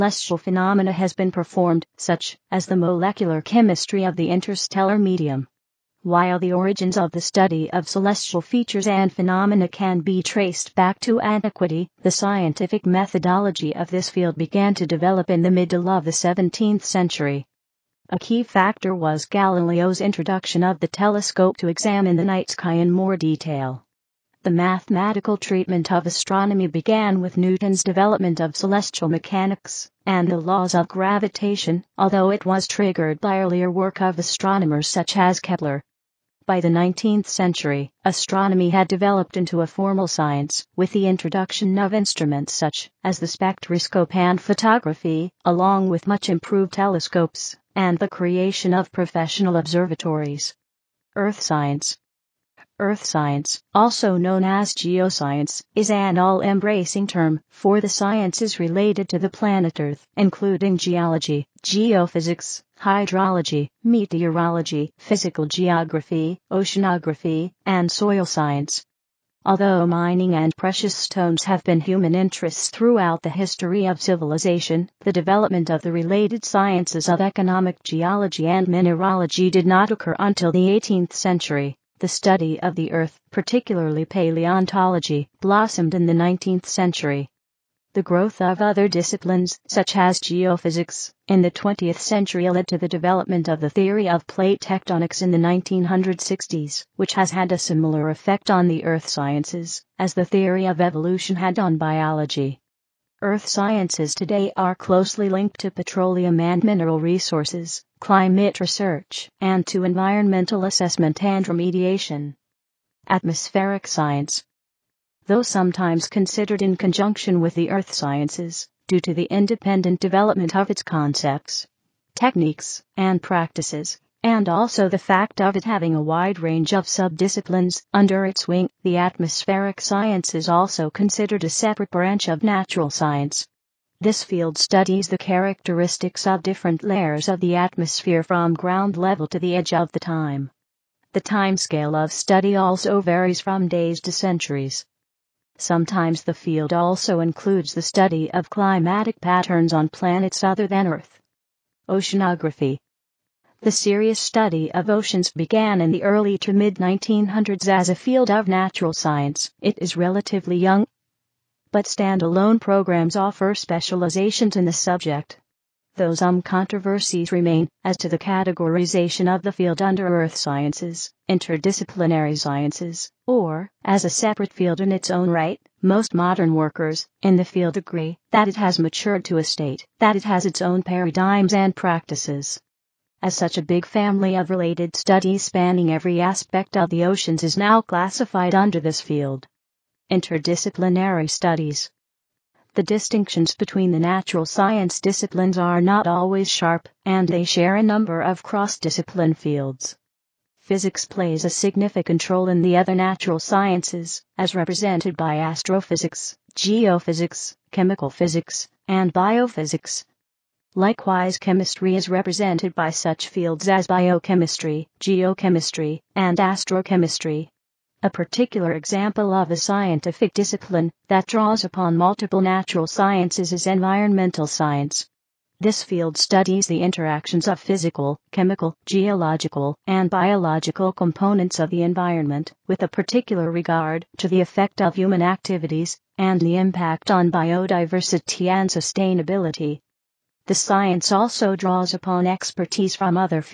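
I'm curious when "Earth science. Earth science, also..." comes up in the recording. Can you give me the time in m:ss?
0:51.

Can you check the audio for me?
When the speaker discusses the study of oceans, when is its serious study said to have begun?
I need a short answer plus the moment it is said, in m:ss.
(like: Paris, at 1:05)
early to mid 1900s, at 2:36.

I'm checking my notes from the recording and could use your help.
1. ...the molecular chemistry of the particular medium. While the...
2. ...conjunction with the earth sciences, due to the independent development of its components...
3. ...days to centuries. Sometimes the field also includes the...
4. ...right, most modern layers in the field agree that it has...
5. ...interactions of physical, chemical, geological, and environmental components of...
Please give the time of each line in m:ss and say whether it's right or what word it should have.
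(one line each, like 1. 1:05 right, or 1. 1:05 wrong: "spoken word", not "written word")
1. 0:02 wrong: "interstellar", not "particular"
2. 1:56 wrong: "concepts", not "components"
3. 2:23 right
4. 2:55 wrong: "workers", not "layers"
5. 3:46 wrong: "biological", not "environmental".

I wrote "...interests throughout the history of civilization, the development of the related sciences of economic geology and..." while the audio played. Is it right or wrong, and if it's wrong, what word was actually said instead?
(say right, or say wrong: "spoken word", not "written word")
right.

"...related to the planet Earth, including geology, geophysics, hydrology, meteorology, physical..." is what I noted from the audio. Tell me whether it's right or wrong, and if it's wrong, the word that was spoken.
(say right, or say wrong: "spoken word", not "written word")
right.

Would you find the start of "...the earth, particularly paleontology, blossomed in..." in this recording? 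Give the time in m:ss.
1:22.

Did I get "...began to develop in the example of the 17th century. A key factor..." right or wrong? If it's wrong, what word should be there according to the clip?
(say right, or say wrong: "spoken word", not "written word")
wrong: "middle", not "example".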